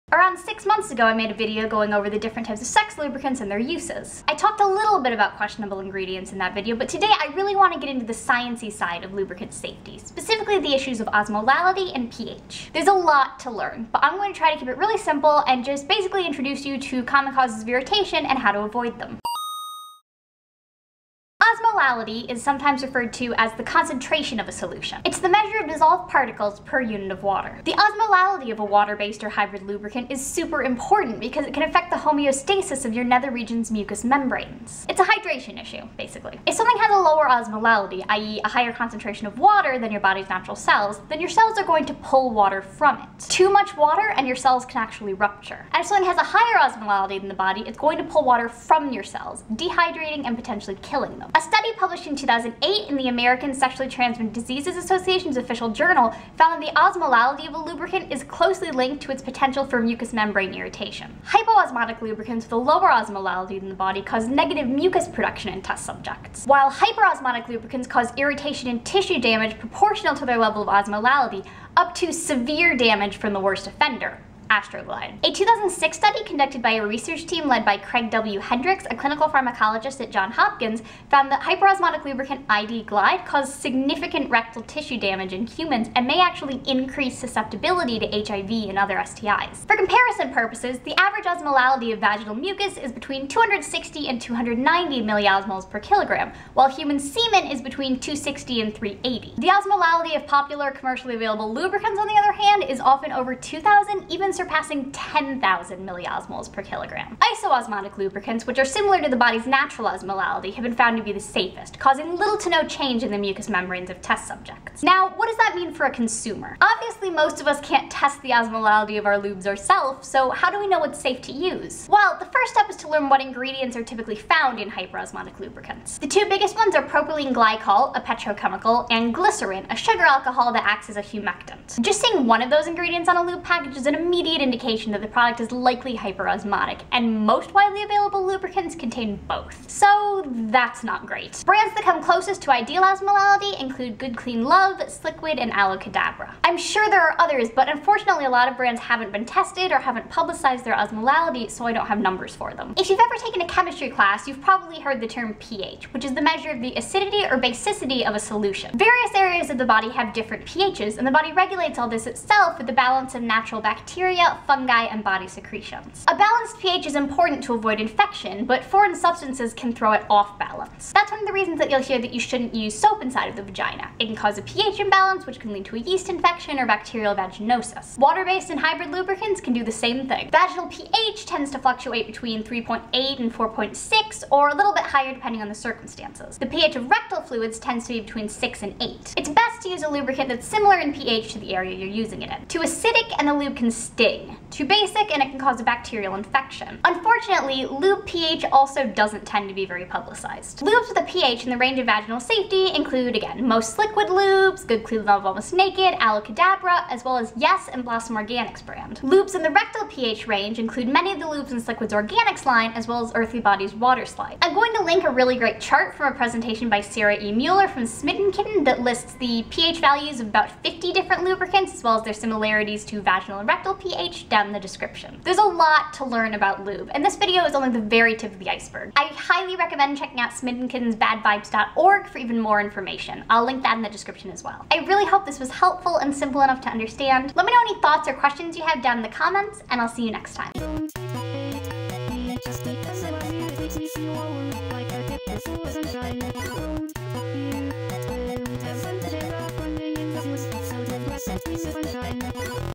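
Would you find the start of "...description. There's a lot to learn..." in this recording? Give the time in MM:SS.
03:44.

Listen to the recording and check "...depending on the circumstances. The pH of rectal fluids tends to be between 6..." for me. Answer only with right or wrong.
right.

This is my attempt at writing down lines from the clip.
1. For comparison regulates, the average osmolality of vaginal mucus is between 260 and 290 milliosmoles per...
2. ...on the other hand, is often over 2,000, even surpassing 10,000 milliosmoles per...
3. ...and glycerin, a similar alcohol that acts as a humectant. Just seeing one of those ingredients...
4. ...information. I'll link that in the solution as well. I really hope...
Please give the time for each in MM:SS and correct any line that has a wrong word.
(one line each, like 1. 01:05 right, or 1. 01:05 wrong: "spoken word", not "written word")
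1. 01:29 wrong: "purposes", not "regulates"
2. 01:41 right
3. 02:08 wrong: "sugar", not "similar"
4. 03:52 wrong: "description", not "solution".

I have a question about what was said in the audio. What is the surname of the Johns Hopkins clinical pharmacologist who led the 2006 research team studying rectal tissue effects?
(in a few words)
Hendrix.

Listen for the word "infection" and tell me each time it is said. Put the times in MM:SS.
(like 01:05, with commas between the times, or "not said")
02:47, 02:56, 03:16.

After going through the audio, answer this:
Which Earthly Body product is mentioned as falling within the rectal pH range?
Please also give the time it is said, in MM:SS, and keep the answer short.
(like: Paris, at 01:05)
Water Slide, at 03:33.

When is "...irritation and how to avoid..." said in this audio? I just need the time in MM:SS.
00:17.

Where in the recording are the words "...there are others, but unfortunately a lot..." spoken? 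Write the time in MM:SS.
02:26.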